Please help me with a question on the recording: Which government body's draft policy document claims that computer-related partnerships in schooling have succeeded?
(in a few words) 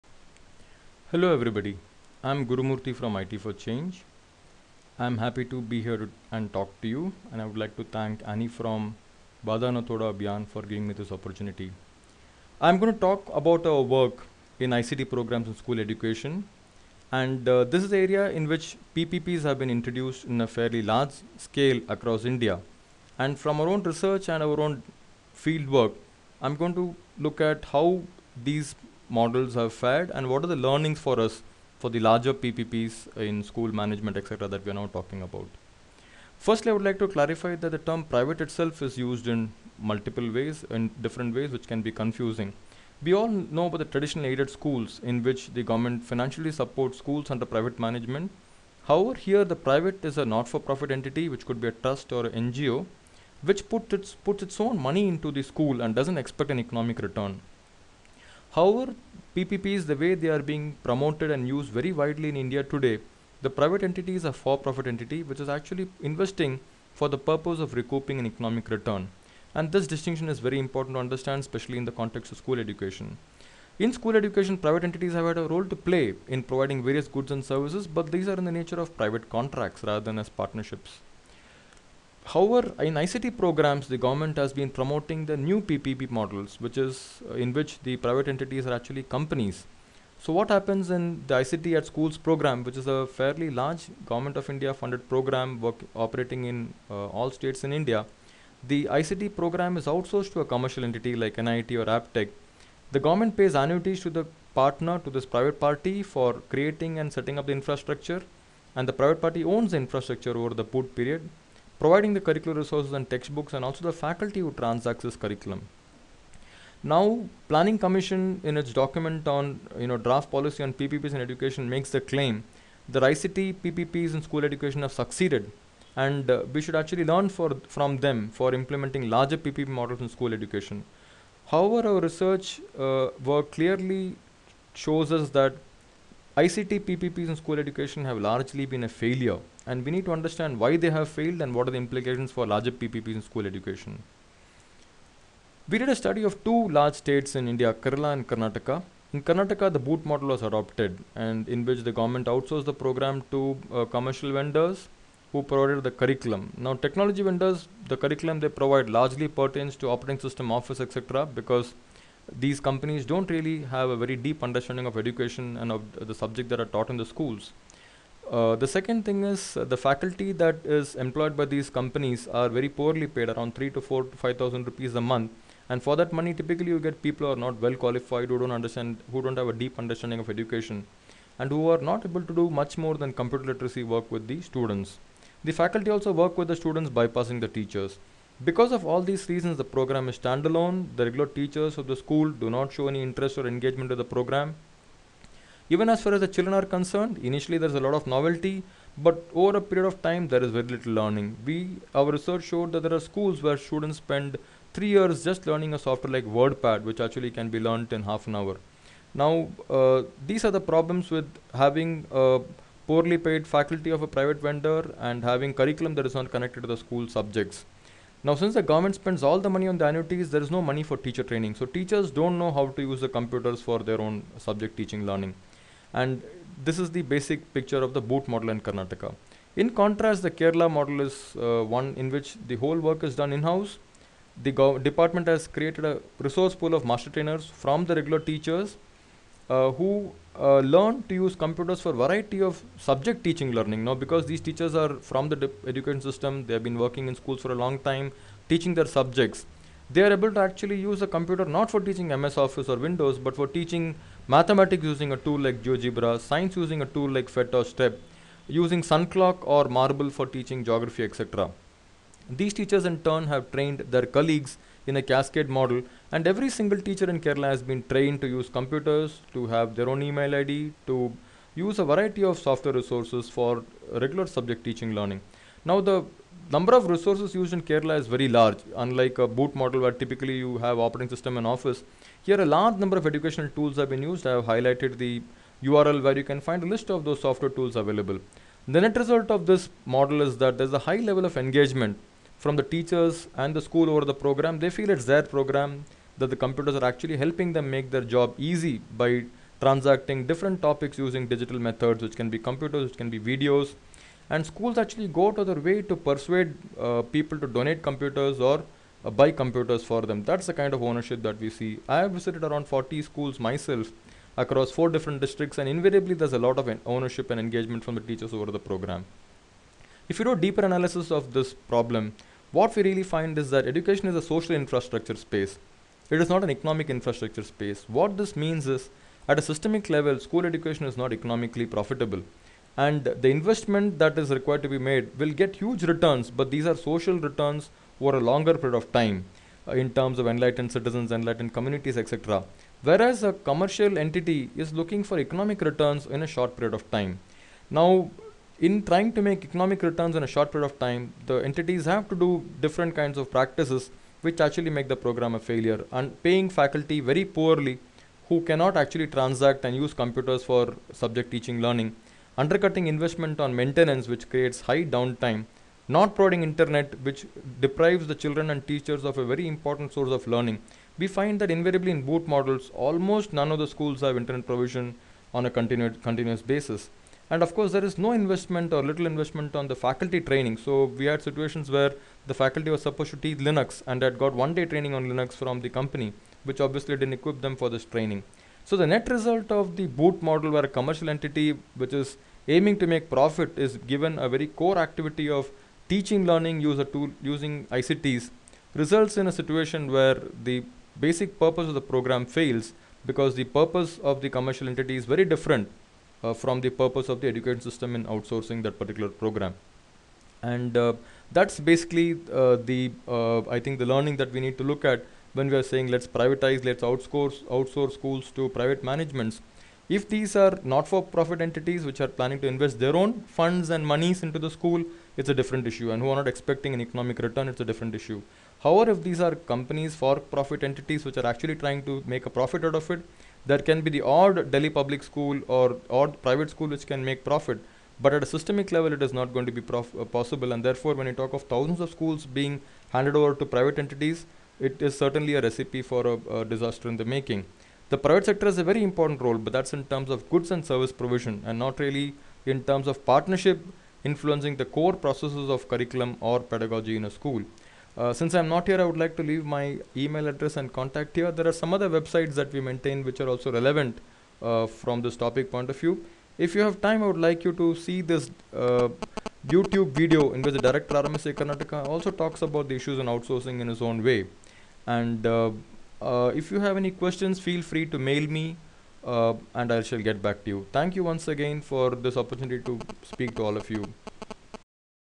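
Planning Commission.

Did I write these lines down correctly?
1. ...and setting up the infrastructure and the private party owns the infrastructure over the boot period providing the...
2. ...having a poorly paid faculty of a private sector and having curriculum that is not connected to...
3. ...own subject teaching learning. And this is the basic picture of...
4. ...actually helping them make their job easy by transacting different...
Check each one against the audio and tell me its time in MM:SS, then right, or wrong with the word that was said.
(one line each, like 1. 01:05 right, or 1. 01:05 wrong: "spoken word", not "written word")
1. 01:46 right
2. 03:31 wrong: "vendor", not "sector"
3. 03:43 right
4. 04:56 right.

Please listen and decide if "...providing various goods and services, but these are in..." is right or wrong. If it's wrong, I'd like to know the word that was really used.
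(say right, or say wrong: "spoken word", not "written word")
right.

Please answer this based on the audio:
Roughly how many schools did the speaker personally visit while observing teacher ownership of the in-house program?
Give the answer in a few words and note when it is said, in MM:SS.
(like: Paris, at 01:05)
40, at 05:12.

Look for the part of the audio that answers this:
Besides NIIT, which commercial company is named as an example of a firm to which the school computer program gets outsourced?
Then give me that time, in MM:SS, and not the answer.
01:41.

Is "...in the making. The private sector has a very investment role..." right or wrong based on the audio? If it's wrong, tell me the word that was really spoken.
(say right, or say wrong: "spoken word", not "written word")
wrong: "important", not "investment".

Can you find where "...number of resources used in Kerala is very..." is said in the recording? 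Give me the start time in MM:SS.
04:36.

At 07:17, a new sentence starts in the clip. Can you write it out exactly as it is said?
But at a systemic level, it is not going to be prof- uh, possible.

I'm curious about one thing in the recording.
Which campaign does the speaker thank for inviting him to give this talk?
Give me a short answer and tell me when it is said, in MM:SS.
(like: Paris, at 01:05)
Wada Na Todo Abhiyan, at 00:09.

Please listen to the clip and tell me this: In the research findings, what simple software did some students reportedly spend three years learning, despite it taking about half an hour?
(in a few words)
WordPad.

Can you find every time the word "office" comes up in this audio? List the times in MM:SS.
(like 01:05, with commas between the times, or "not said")
02:40, 04:12, 04:41.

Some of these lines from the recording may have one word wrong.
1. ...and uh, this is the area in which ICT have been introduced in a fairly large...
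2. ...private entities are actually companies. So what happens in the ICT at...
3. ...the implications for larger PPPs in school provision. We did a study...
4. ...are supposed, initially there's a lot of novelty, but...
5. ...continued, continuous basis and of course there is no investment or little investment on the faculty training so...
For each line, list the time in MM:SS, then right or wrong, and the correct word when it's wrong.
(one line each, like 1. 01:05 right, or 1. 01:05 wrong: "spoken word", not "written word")
1. 00:17 wrong: "PPPs", not "ICT"
2. 01:27 right
3. 02:21 wrong: "education", not "provision"
4. 03:16 wrong: "concerned", not "supposed"
5. 06:15 right.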